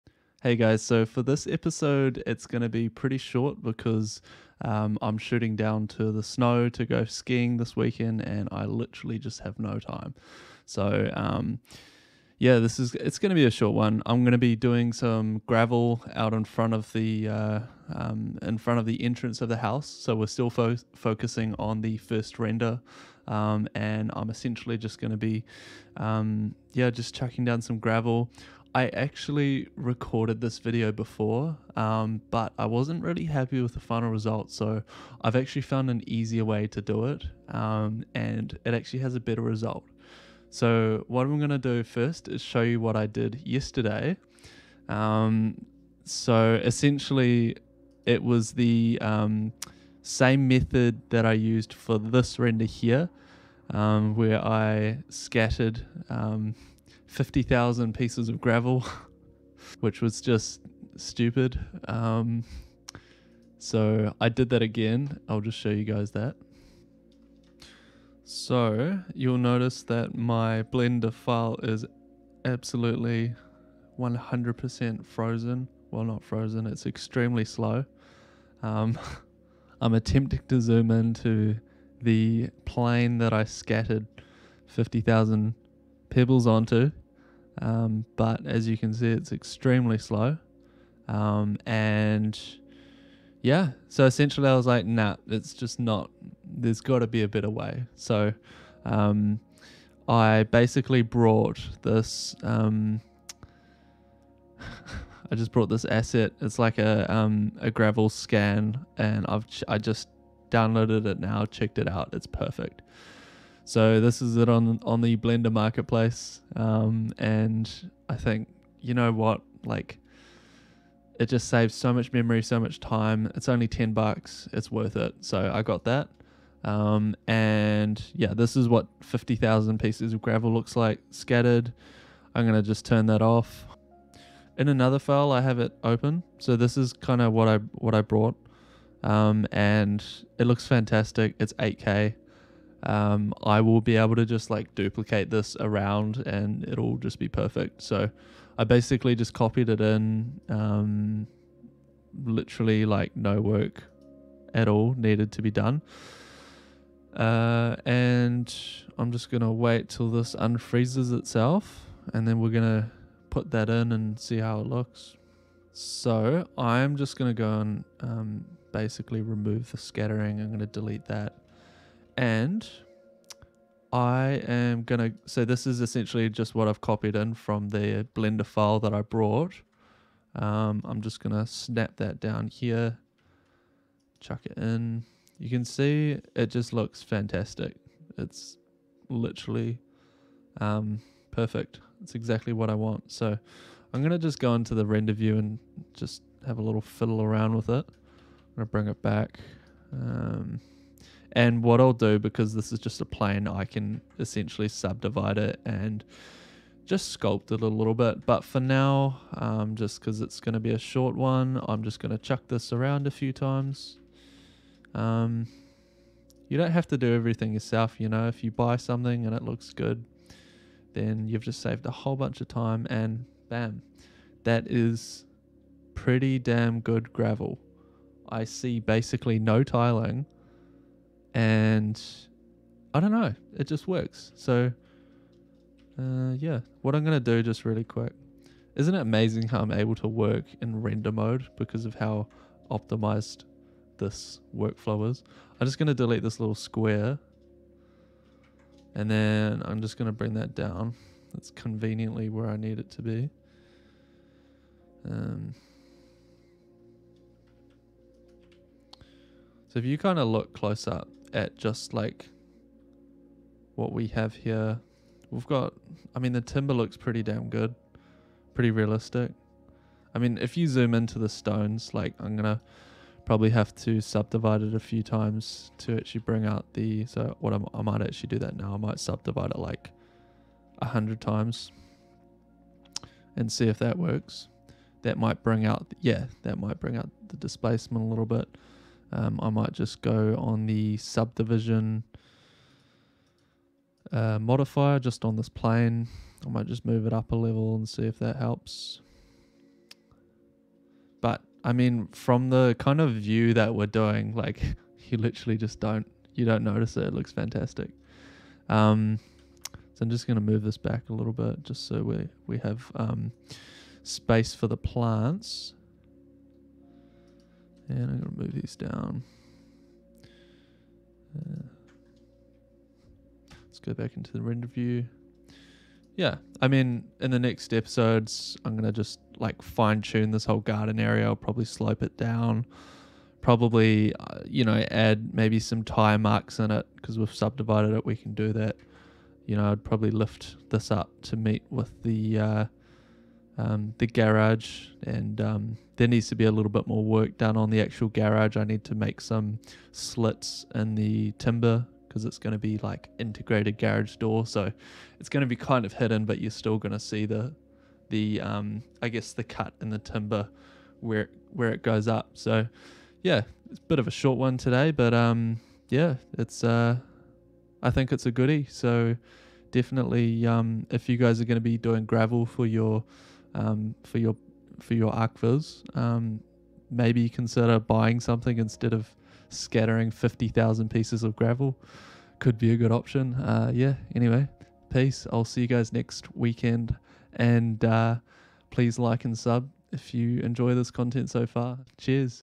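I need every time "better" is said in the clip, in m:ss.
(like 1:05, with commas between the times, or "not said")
0:39, 1:37.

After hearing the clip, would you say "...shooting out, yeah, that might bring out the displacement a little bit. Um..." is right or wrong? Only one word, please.
wrong.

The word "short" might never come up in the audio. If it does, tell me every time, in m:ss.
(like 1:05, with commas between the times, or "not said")
0:03, 0:13, 3:30, 6:04.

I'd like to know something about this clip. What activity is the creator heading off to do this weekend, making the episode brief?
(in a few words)
Skiing.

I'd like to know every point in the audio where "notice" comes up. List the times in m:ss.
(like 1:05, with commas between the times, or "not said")
1:09, 5:06.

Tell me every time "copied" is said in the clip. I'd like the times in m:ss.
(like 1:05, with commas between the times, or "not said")
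2:29, 2:56.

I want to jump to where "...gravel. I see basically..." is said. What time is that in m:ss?
3:47.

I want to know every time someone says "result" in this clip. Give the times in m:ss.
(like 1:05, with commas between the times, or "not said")
0:34, 0:39.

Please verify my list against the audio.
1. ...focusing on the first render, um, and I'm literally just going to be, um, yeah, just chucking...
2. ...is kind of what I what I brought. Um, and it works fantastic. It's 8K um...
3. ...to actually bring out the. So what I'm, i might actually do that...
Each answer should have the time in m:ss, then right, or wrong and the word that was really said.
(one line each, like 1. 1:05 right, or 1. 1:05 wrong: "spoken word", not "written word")
1. 0:20 wrong: "essentially", not "literally"
2. 2:16 wrong: "looks", not "works"
3. 4:35 right.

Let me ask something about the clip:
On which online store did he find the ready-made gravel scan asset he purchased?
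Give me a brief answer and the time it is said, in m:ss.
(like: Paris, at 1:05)
Blender marketplace, at 1:55.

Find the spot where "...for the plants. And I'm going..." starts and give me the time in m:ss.
5:14.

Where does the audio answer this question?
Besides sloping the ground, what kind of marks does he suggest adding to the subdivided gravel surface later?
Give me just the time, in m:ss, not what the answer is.
5:35.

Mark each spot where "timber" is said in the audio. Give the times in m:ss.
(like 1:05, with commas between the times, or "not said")
4:26, 5:51, 5:59.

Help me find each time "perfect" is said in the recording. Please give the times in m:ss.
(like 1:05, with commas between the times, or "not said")
1:52, 2:27, 3:11.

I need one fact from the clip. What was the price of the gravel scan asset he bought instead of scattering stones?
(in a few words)
$10.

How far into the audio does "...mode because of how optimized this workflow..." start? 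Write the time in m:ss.
4:01.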